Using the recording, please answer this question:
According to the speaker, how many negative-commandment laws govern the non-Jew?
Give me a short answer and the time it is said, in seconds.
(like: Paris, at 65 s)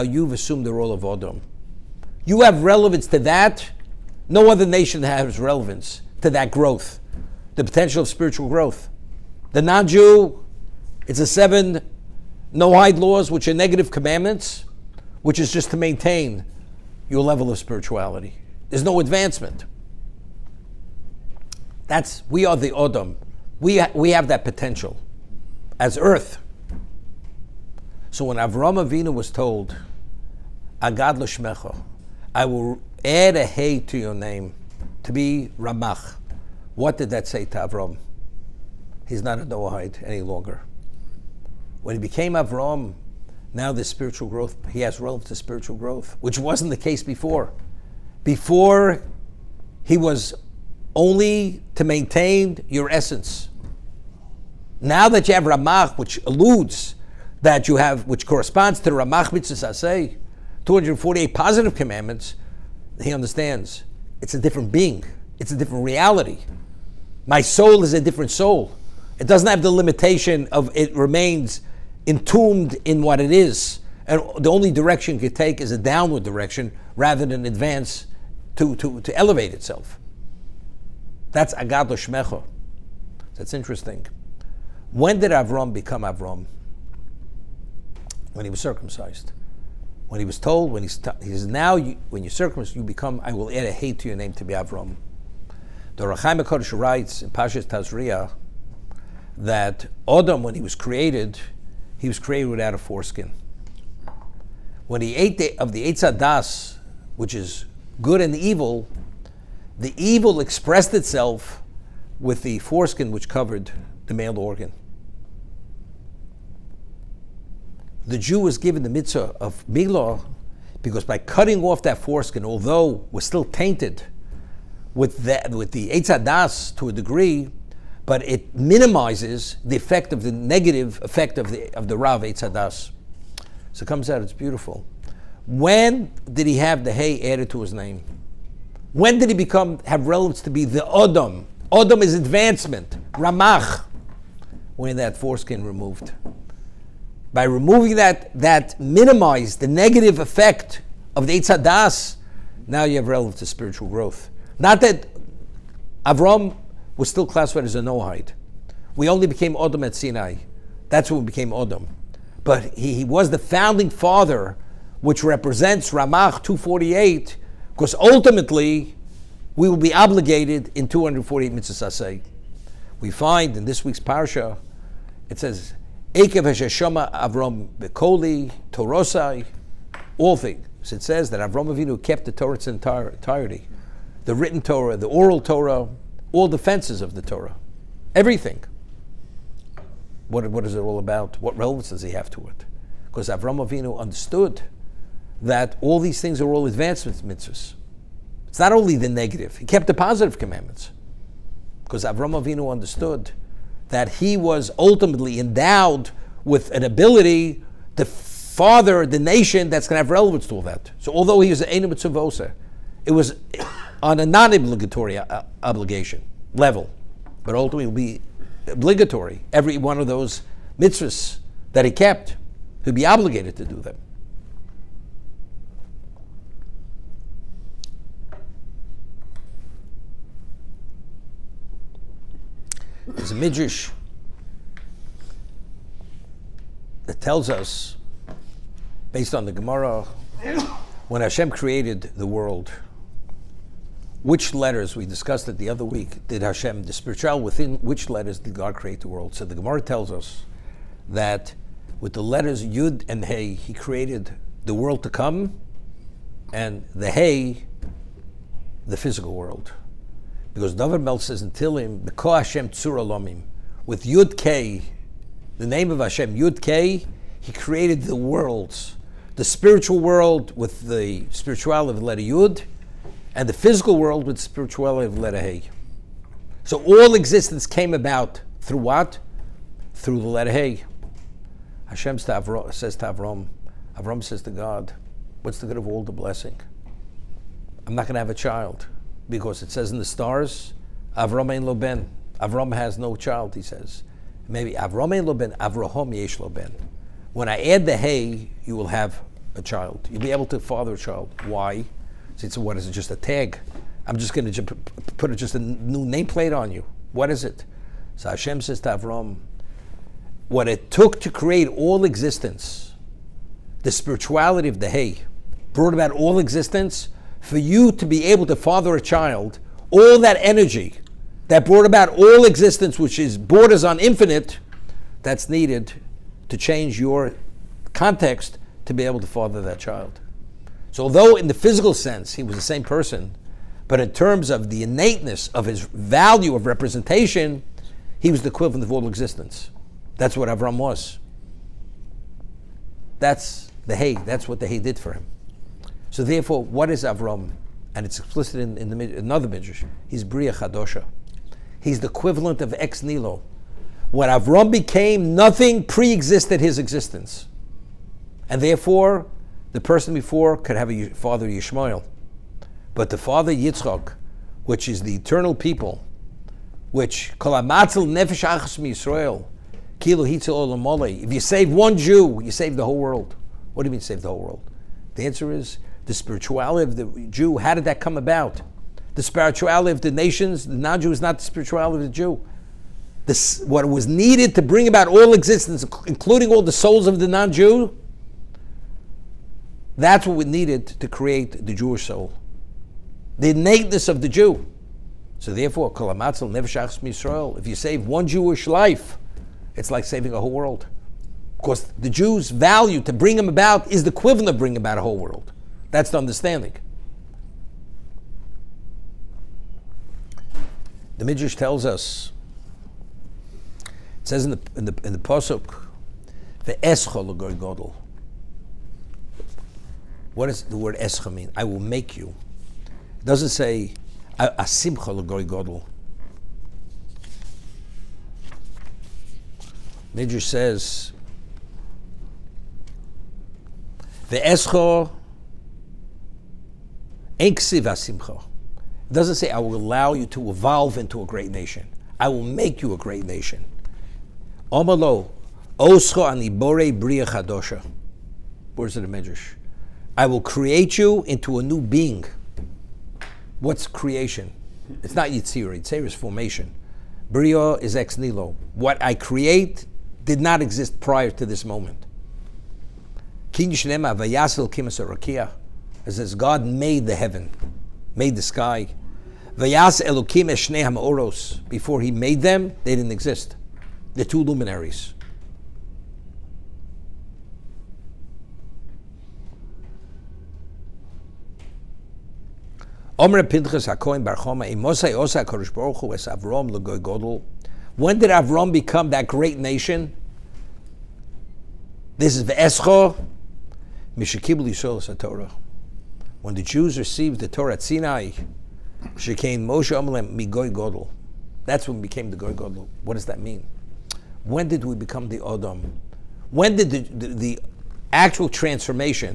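7, at 11 s.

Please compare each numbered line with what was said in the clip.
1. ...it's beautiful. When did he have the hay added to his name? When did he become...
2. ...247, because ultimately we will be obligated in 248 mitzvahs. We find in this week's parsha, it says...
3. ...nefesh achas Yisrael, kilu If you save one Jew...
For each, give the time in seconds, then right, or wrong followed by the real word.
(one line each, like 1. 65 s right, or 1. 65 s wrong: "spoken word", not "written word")
1. 134 s right
2. 166 s wrong: "248", not "247"
3. 368 s right.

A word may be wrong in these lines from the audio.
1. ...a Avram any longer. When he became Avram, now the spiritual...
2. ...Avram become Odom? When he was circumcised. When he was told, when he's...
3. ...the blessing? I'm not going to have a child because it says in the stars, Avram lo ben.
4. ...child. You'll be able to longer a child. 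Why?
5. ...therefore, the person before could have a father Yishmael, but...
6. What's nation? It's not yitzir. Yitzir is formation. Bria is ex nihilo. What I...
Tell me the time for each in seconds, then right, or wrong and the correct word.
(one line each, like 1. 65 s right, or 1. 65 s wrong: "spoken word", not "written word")
1. 39 s wrong: "Noahide", not "Avram"
2. 85 s wrong: "Avram", not "Odom"
3. 286 s right
4. 299 s wrong: "father", not "longer"
5. 358 s right
6. 453 s wrong: "creation", not "nation".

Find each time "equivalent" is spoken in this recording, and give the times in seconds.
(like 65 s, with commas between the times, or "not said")
338 s, 352 s, 404 s.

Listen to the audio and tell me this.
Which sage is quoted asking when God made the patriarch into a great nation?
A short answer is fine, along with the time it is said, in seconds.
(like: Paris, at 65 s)
Pinchas HaKoin, at 483 s.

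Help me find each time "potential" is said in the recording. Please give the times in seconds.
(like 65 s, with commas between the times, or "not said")
7 s, 24 s.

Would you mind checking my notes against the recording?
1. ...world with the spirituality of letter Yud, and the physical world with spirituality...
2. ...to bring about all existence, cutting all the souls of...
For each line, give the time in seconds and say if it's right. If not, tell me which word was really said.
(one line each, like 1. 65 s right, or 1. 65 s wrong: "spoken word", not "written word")
1. 269 s right
2. 384 s wrong: "including", not "cutting".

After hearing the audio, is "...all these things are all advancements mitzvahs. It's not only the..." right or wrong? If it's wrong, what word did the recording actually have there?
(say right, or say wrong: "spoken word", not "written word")
right.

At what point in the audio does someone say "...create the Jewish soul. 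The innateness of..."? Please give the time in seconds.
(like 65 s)
391 s.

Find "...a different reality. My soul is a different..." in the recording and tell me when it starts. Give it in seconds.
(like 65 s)
65 s.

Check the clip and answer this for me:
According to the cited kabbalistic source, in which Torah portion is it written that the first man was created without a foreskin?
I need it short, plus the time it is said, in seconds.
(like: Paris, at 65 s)
Tazria, at 97 s.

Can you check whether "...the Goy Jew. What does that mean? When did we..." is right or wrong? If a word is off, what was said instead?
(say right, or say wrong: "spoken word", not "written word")
wrong: "Godel", not "Jew".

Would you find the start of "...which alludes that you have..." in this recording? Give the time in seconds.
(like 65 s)
55 s.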